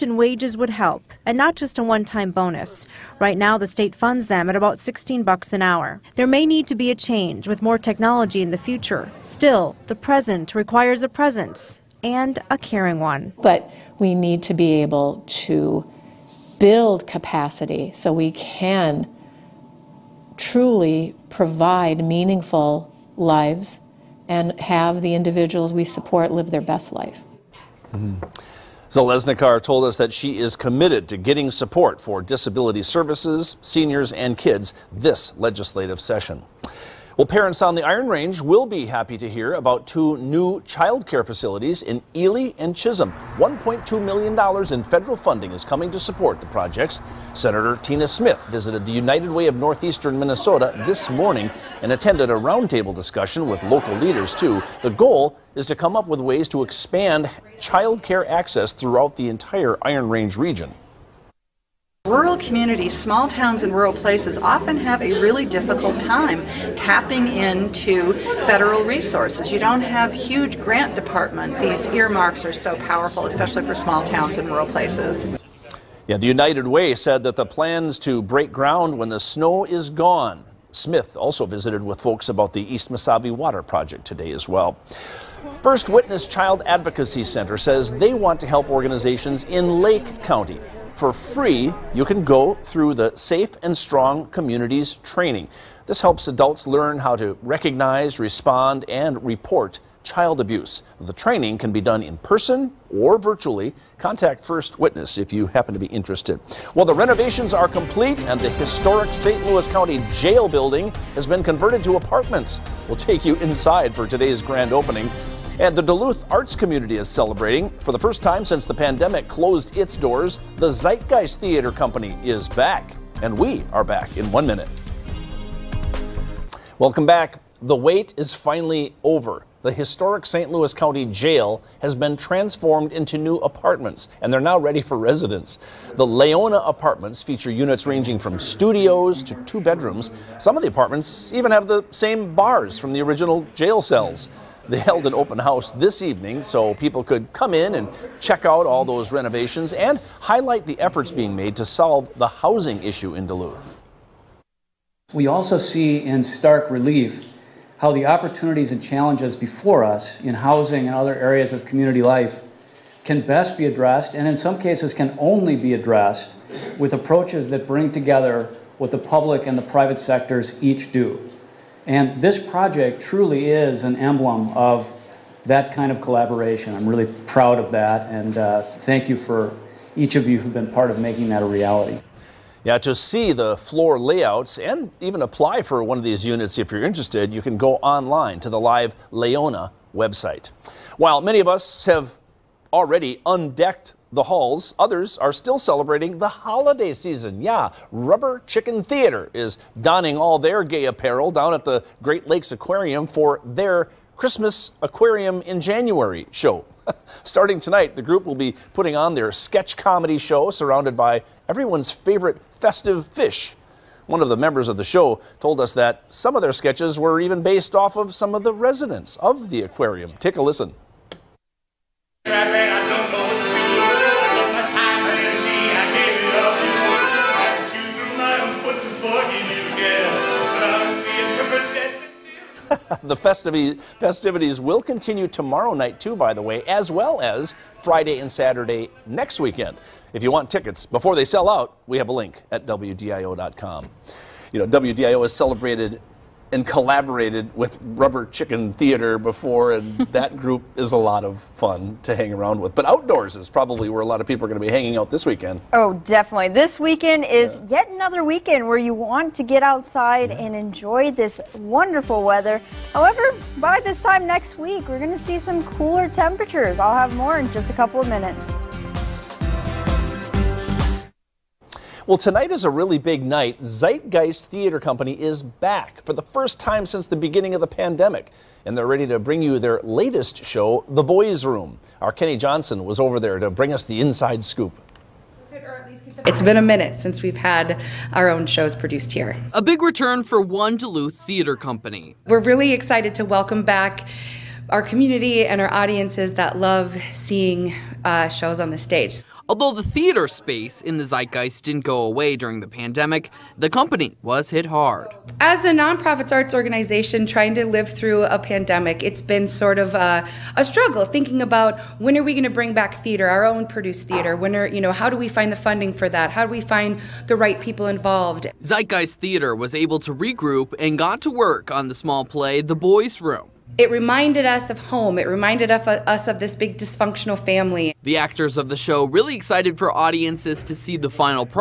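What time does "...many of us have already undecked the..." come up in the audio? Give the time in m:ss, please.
3:11.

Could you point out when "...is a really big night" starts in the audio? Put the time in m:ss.
4:32.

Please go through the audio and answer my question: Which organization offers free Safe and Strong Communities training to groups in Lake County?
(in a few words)
First Witness Child Advocacy Center.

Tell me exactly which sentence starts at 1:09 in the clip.
You don't have huge grant departments.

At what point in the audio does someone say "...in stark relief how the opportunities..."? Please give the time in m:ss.
2:36.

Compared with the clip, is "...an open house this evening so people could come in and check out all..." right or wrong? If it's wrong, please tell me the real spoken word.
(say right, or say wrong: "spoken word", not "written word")
right.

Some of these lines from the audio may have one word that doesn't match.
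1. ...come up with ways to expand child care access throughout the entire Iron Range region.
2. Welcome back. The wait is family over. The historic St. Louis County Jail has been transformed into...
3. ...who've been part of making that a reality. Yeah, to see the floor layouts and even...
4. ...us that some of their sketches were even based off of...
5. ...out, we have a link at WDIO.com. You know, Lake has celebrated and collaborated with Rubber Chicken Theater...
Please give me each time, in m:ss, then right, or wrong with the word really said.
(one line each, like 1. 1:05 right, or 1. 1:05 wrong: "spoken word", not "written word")
1. 0:55 right
2. 2:06 wrong: "finally", not "family"
3. 3:00 right
4. 3:35 right
5. 4:01 wrong: "WDIO", not "Lake".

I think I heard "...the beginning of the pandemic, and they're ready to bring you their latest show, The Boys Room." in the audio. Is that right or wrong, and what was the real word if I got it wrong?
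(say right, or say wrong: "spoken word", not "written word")
right.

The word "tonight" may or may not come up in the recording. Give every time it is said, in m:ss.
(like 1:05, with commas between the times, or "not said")
3:27, 4:32.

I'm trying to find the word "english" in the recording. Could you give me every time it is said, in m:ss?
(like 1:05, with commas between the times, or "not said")
not said.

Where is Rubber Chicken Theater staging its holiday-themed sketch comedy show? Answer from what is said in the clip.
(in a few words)
Great Lakes Aquarium.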